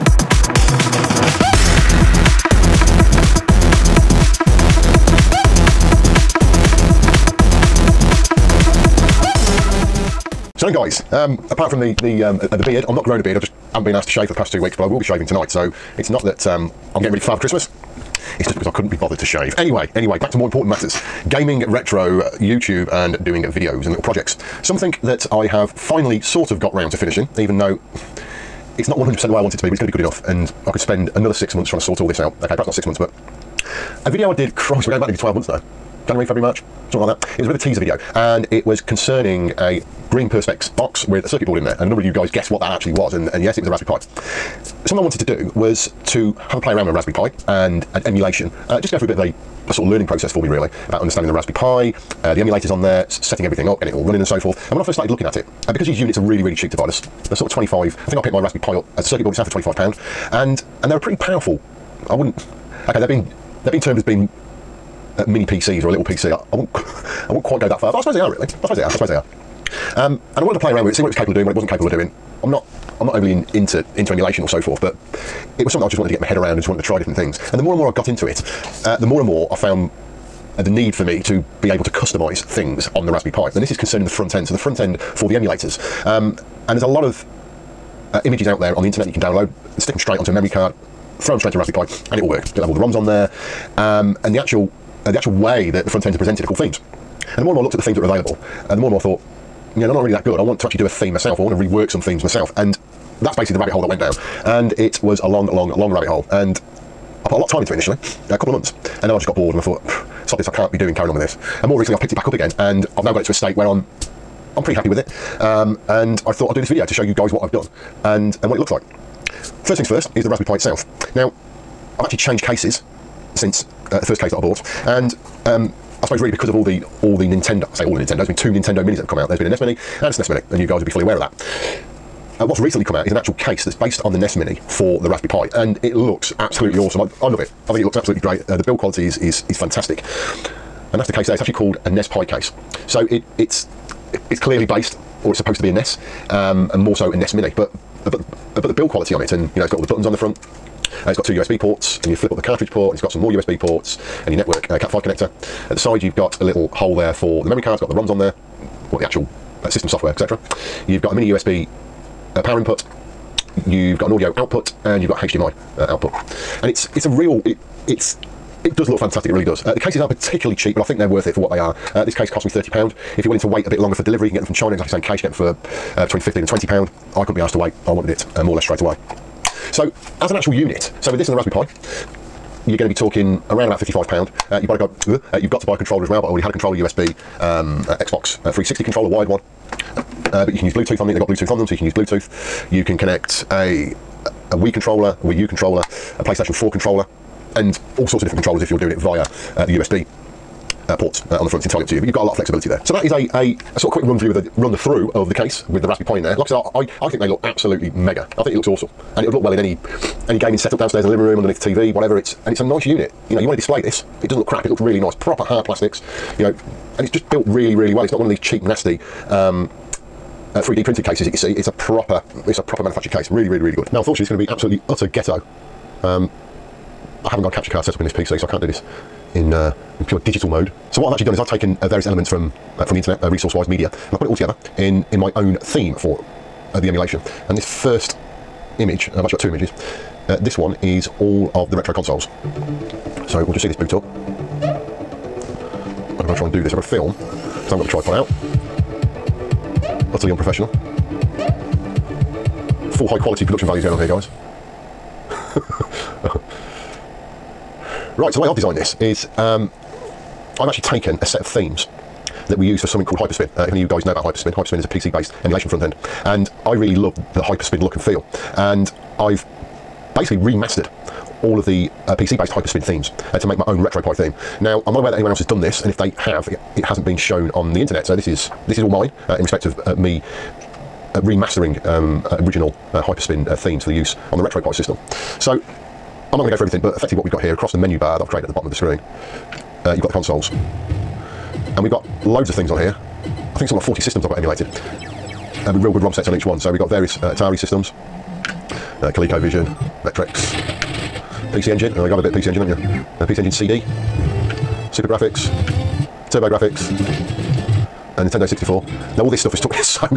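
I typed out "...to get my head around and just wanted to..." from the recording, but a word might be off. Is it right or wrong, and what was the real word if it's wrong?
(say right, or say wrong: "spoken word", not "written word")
right.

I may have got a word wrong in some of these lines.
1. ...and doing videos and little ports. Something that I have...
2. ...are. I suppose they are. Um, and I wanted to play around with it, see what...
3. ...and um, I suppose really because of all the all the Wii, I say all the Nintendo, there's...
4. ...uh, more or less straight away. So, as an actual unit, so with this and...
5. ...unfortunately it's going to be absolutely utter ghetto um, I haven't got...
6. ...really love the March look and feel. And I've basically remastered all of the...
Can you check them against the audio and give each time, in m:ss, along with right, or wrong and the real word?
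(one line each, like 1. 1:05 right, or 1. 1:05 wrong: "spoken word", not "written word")
1. 0:22 wrong: "projects", not "ports"
2. 1:08 right
3. 2:04 wrong: "Nintendo", not "Wii"
4. 2:58 right
5. 3:44 right
6. 4:26 wrong: "Hyperspin", not "March".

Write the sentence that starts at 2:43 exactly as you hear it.
You've got an audio output, and you've got HDMI uh, output.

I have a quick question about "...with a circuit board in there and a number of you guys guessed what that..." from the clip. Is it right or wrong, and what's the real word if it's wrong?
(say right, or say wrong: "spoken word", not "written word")
right.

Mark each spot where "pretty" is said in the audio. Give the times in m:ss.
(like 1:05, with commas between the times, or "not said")
1:00, 1:54.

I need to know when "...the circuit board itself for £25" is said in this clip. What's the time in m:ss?
0:59.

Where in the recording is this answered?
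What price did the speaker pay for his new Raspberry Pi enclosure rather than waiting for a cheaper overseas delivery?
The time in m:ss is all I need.
2:52.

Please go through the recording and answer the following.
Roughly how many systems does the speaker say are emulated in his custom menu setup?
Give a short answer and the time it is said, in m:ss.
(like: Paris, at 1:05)
40, at 4:53.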